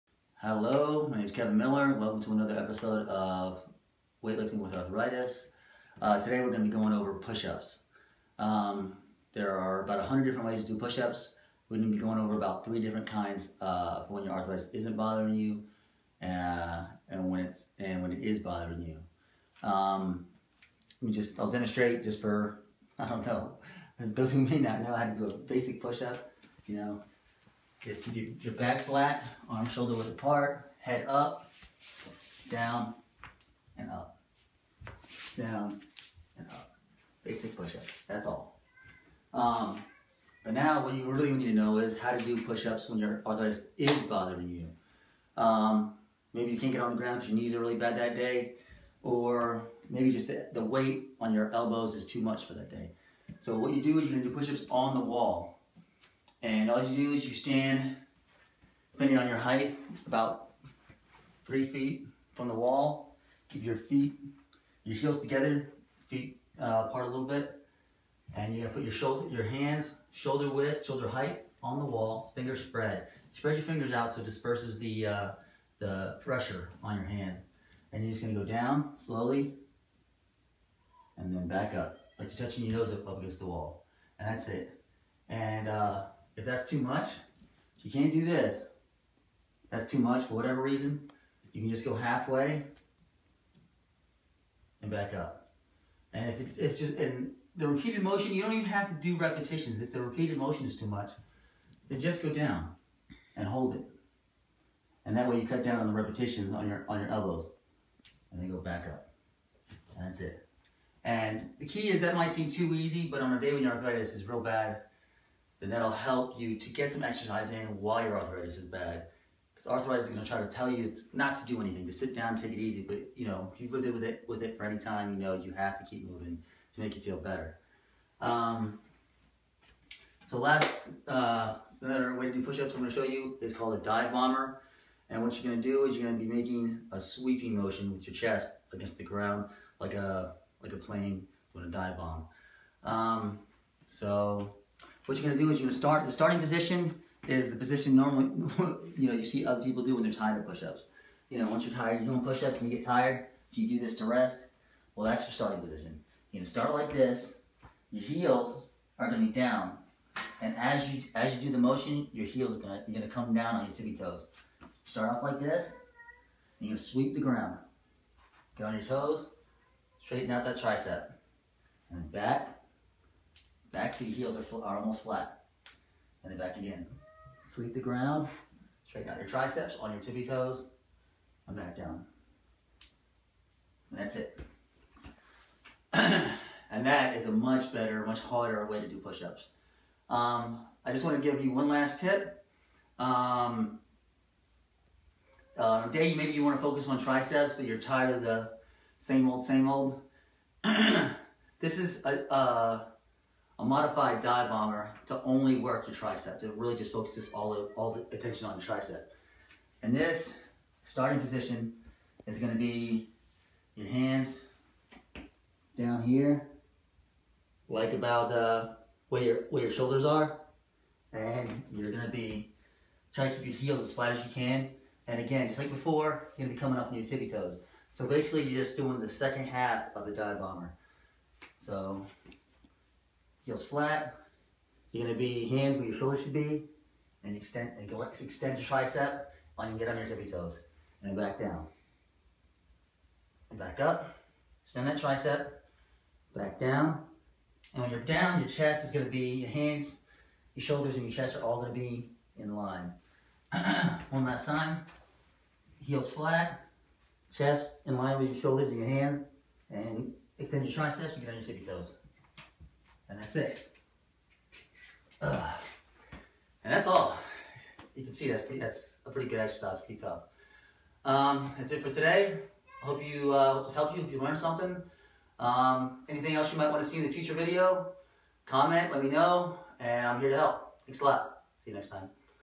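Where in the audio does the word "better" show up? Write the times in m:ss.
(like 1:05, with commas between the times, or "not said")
2:07, 3:07.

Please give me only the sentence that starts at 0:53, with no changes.
So what you do is you're gonna do push-ups on the wall.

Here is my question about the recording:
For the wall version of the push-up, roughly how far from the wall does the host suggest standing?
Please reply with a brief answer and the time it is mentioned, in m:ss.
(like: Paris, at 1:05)
3 feet, at 1:01.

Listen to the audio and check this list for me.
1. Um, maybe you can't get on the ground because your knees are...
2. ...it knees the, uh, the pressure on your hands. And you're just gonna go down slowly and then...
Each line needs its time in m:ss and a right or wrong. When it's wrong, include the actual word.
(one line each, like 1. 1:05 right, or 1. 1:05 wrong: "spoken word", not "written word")
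1. 0:45 right
2. 1:14 wrong: "disperses", not "knees".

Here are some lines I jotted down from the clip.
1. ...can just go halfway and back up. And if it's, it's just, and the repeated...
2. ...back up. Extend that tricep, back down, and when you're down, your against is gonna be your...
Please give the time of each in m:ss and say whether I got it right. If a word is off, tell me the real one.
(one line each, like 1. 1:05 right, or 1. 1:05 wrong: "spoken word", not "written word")
1. 1:31 right
2. 4:03 wrong: "chest", not "against".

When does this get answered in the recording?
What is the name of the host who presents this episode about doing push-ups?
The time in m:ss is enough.
0:01.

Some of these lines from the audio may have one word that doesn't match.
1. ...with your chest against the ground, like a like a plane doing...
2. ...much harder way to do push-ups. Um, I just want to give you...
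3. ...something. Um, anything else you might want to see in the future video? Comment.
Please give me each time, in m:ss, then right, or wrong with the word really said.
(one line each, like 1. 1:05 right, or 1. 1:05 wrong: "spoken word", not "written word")
1. 2:17 right
2. 3:08 right
3. 4:34 right.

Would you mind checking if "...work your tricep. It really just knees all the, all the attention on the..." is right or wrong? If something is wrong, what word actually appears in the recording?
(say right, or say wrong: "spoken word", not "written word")
wrong: "focuses", not "knees".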